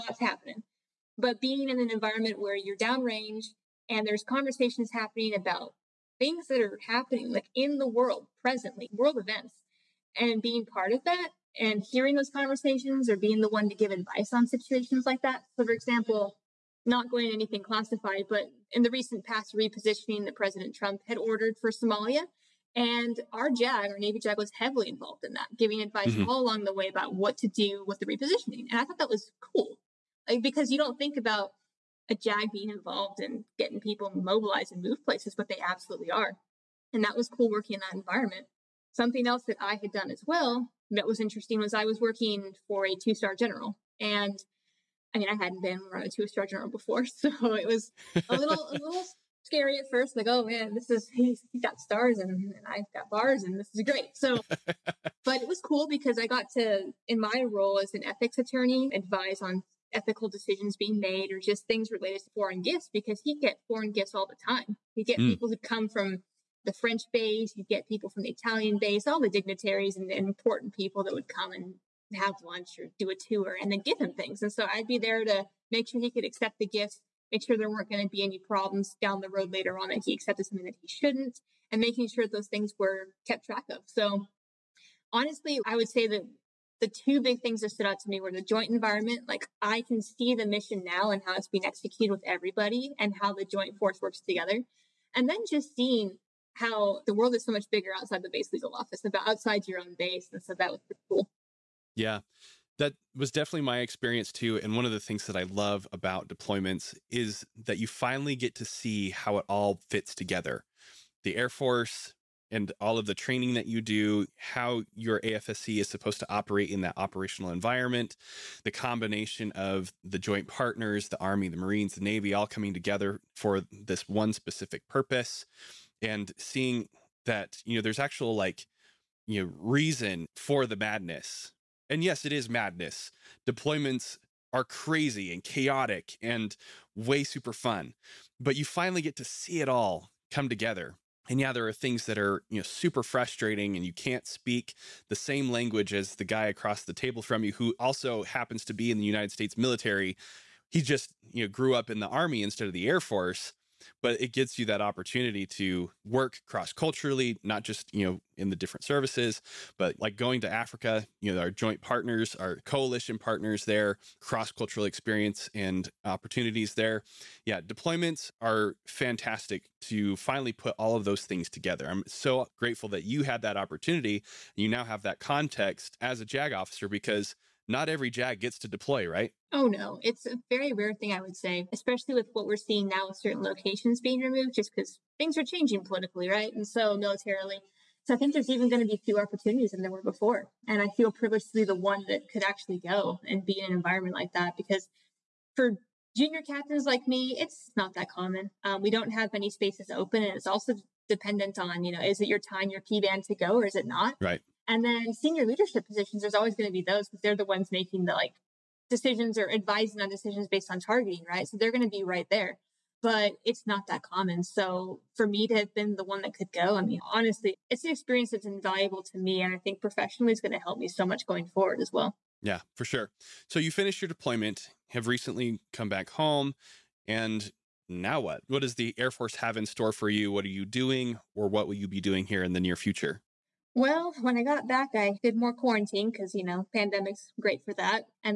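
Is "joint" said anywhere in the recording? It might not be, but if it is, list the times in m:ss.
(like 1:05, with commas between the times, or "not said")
1:28, 1:33, 2:00, 2:41.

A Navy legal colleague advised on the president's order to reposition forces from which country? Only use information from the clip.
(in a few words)
Somalia.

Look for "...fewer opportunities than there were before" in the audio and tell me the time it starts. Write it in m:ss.
3:09.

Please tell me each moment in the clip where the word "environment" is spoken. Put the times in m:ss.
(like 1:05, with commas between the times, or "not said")
0:01, 0:37, 1:28, 1:57, 3:13.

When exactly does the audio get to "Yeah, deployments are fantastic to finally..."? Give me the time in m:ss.
2:47.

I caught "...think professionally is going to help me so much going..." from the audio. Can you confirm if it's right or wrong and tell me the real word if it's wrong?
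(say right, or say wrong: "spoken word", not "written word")
right.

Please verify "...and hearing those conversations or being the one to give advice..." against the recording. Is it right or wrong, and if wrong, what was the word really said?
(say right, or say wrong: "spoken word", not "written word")
right.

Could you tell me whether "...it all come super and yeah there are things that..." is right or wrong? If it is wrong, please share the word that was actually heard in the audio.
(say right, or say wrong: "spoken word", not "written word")
wrong: "together", not "super".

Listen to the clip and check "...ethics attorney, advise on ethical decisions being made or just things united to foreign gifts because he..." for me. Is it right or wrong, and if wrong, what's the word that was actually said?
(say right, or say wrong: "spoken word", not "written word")
wrong: "related", not "united".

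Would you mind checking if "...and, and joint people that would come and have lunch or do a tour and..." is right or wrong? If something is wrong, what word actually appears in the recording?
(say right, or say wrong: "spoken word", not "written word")
wrong: "important", not "joint".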